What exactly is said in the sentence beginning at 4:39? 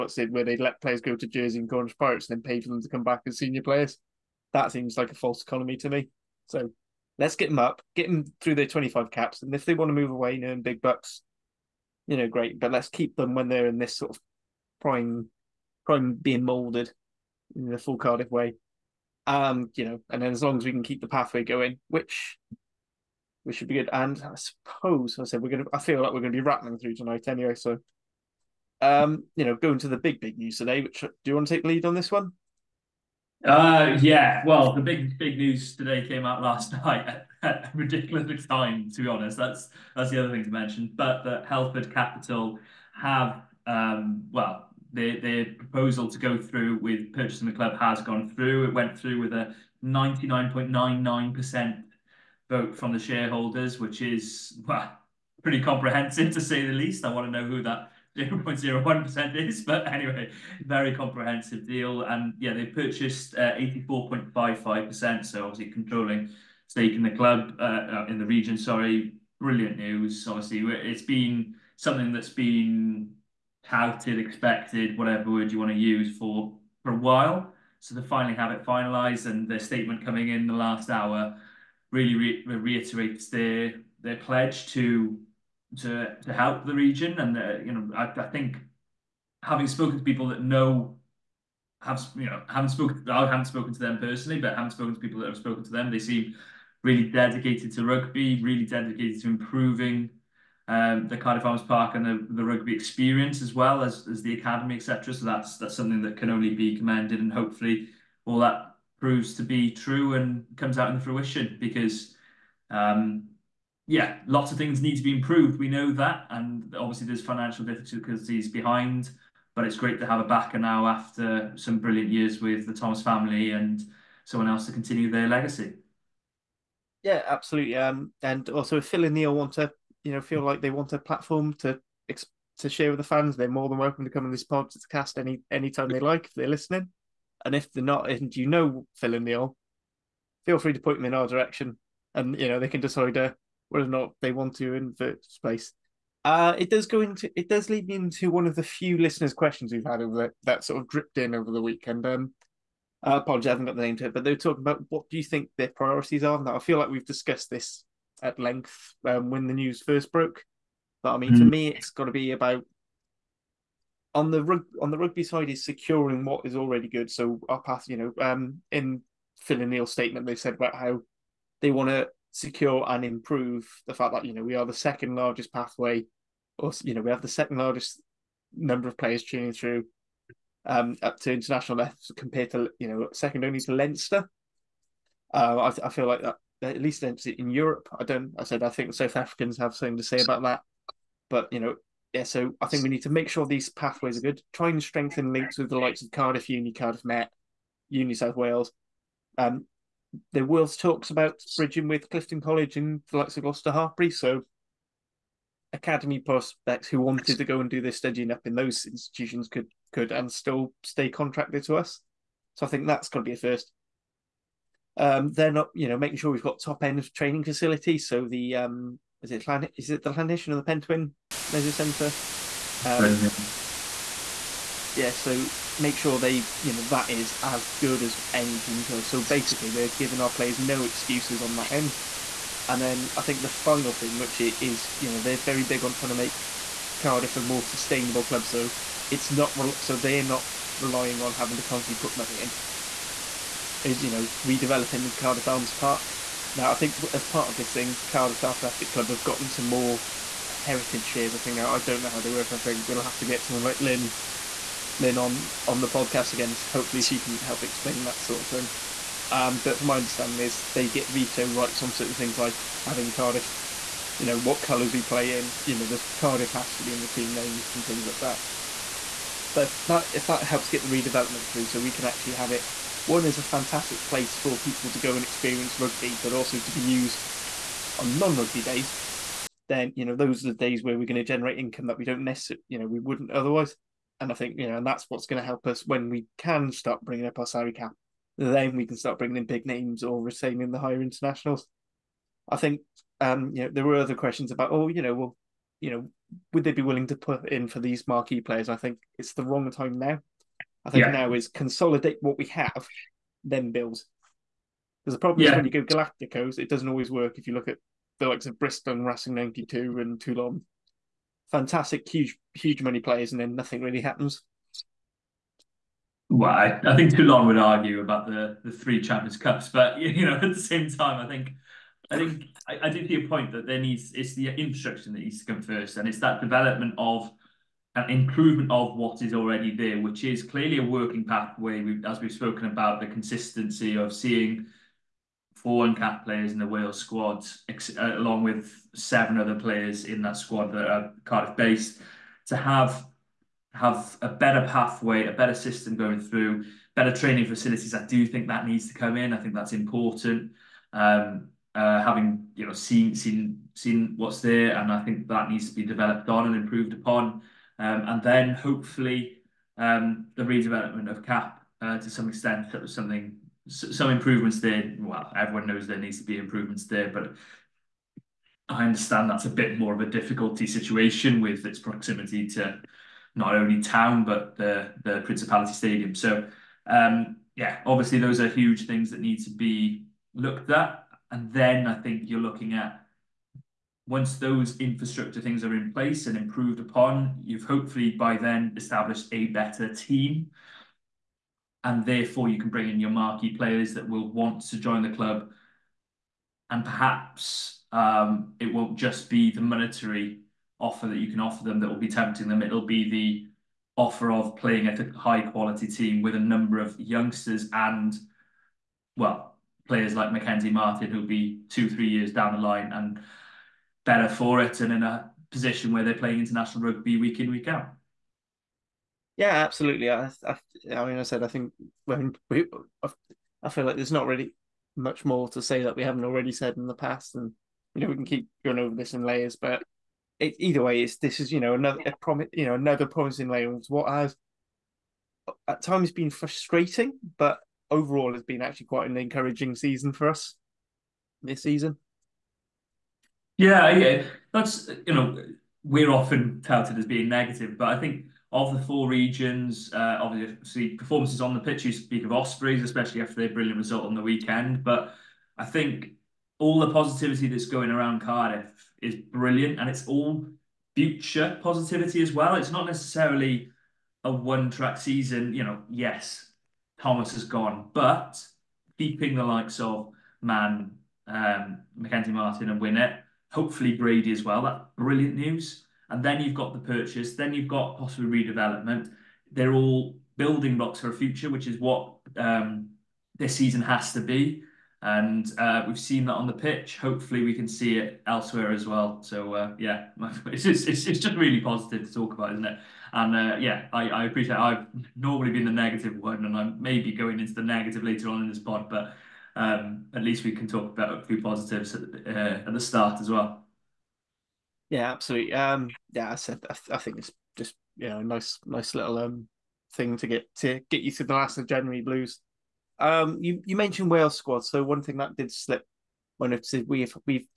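Then you know those are the days where we're going to generate income that we don't necessarily, you know, we wouldn't otherwise.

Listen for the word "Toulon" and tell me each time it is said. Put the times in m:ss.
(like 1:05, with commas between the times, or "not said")
5:10, 5:17.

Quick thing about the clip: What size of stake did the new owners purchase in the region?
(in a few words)
84.55%.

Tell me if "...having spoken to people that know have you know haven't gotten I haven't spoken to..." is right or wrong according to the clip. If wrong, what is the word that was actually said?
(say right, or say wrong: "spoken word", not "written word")
wrong: "spoken", not "gotten".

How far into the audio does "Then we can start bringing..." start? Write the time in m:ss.
4:48.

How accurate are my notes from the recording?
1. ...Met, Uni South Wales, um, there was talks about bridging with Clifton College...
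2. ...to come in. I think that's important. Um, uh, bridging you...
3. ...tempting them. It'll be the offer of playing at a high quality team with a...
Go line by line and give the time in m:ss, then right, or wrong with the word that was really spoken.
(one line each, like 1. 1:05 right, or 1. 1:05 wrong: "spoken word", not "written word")
1. 3:17 right
2. 5:48 wrong: "having", not "bridging"
3. 6:42 right.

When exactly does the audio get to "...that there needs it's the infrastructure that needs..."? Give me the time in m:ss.
5:23.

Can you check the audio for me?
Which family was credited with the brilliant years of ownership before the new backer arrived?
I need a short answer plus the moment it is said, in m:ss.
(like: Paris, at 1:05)
The Thomas family, at 2:02.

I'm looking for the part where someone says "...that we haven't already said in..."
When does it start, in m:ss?
7:05.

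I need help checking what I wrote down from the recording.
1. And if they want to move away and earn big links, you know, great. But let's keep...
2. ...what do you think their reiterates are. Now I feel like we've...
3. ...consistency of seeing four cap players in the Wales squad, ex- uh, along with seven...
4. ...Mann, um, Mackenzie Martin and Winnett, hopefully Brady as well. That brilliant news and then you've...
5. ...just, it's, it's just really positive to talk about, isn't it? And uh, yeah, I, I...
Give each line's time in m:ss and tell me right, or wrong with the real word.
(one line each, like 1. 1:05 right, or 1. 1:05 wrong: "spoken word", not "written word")
1. 0:09 wrong: "bucks", not "links"
2. 2:34 wrong: "priorities", not "reiterates"
3. 5:33 right
4. 7:50 right
5. 8:10 right.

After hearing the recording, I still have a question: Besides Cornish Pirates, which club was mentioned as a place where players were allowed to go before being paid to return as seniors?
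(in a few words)
Jersey.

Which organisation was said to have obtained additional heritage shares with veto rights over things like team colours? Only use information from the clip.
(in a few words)
Cardiff Athletic Club.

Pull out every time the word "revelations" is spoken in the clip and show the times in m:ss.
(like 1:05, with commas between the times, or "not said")
not said.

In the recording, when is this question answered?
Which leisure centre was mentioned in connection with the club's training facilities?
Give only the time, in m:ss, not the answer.
3:40.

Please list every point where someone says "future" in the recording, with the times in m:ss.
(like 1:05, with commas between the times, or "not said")
7:40, 8:01.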